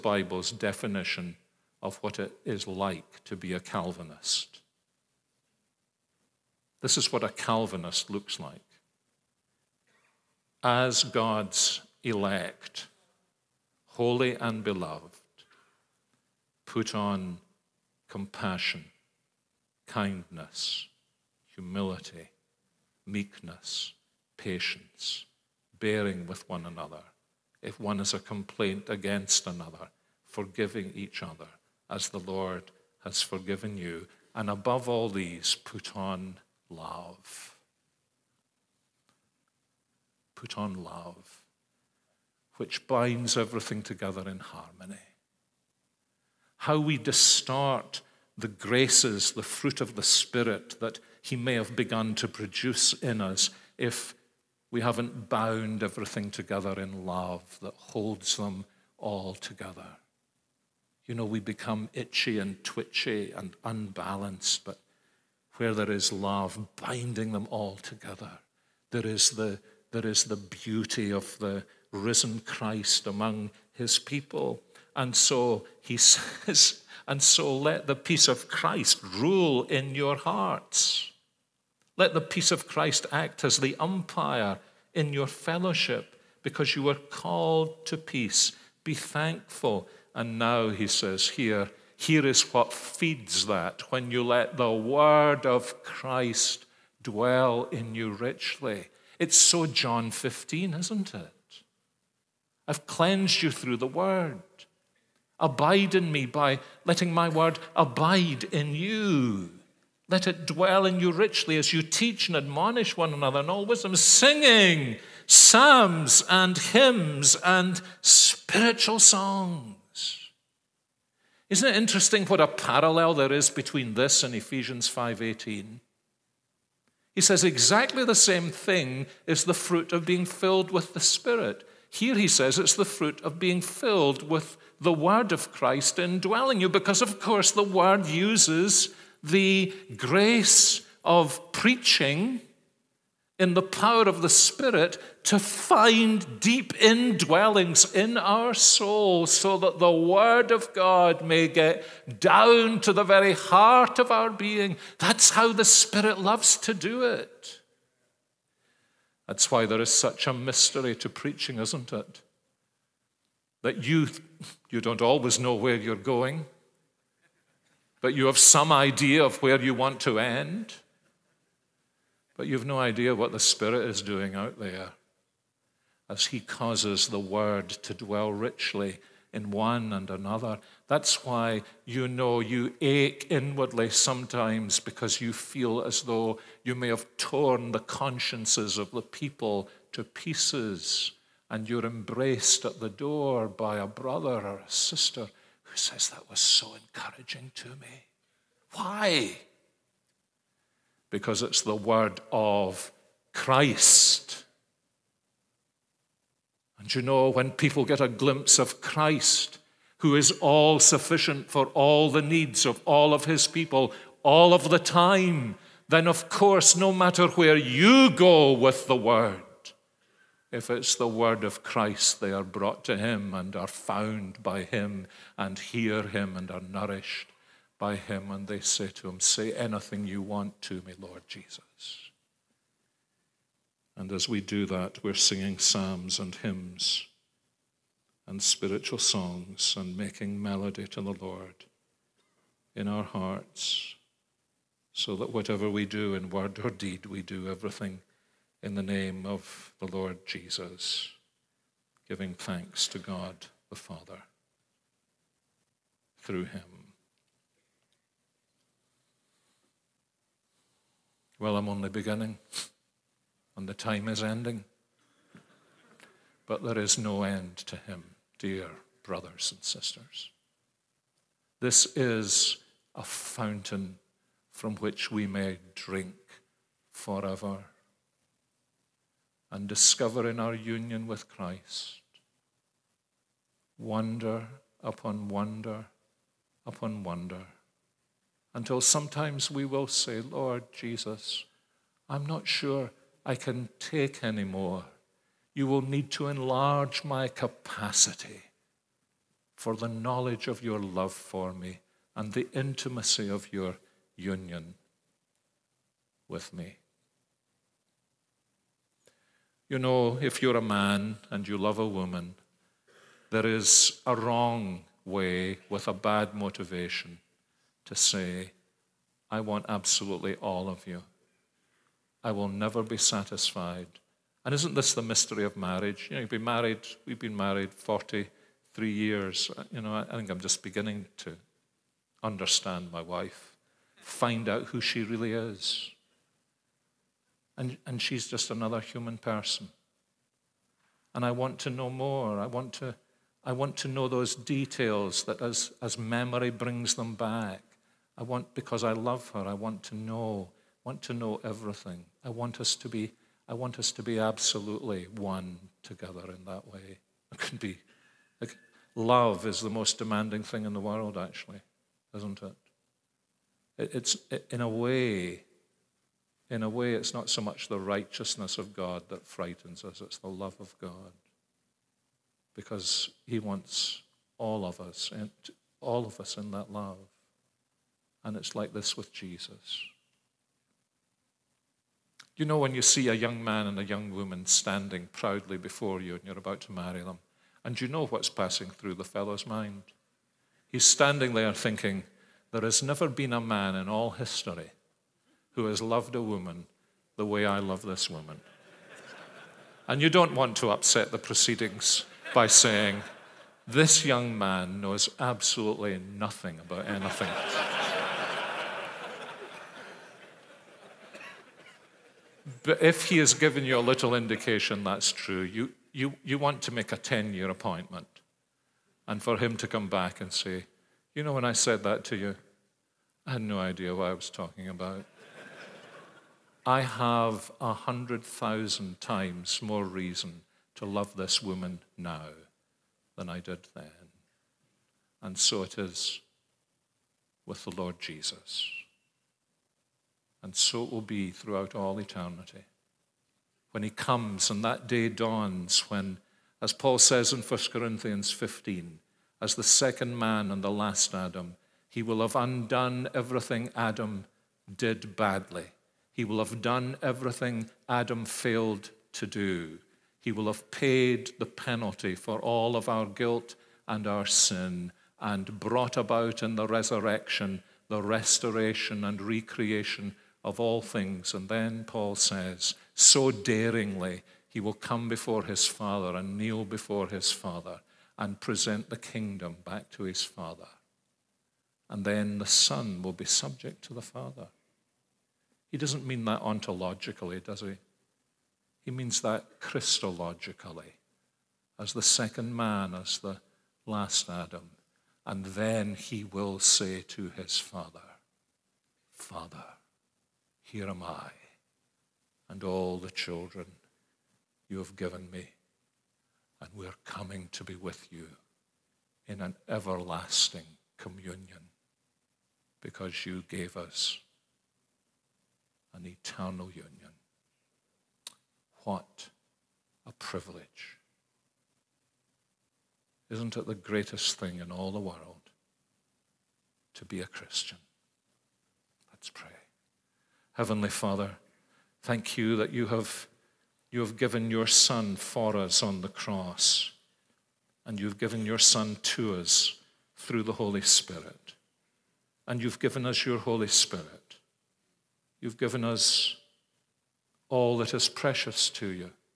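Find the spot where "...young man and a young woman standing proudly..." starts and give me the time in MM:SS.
06:23.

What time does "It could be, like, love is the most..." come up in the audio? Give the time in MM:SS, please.
05:57.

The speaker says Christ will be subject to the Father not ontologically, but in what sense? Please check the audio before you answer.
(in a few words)
Christologically.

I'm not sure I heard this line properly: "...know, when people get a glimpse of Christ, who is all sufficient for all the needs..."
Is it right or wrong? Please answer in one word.
right.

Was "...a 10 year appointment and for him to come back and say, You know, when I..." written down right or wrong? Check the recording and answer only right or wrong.
right.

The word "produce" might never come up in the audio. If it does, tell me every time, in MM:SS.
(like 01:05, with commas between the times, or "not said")
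00:52.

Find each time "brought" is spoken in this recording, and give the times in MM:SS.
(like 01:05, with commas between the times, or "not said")
03:42, 07:45.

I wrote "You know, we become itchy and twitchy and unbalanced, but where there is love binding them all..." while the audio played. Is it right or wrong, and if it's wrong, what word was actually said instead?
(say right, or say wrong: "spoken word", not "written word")
right.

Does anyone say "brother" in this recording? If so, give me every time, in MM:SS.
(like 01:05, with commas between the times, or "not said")
03:13, 04:29.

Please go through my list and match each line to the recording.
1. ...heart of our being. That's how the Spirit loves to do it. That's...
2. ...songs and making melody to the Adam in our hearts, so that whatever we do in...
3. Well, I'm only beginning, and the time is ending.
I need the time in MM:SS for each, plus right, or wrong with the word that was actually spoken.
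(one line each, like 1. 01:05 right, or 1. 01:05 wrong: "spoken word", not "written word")
1. 02:33 right
2. 03:58 wrong: "Lord", not "Adam"
3. 04:21 right.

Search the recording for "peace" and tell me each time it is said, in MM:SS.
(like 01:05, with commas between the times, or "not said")
01:17, 01:22, 01:27.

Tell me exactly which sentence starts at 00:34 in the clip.
And above all these, put on love.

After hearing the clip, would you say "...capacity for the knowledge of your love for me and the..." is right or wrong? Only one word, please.
right.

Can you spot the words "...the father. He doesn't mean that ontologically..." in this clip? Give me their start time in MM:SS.
08:03.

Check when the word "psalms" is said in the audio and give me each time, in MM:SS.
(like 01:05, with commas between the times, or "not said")
01:55, 03:55.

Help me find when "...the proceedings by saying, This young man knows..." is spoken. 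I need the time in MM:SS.
06:41.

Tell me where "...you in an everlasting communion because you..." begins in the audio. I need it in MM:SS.
08:28.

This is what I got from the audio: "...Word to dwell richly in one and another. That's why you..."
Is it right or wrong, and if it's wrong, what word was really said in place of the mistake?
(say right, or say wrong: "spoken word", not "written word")
right.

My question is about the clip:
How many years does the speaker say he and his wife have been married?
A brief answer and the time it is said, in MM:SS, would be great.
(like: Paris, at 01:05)
43, at 05:27.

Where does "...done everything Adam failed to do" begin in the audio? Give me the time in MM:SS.
07:36.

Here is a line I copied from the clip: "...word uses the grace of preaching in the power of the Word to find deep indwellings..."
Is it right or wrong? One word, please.
wrong.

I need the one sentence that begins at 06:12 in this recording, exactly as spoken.
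Because He wants all of us, and all of us in that love.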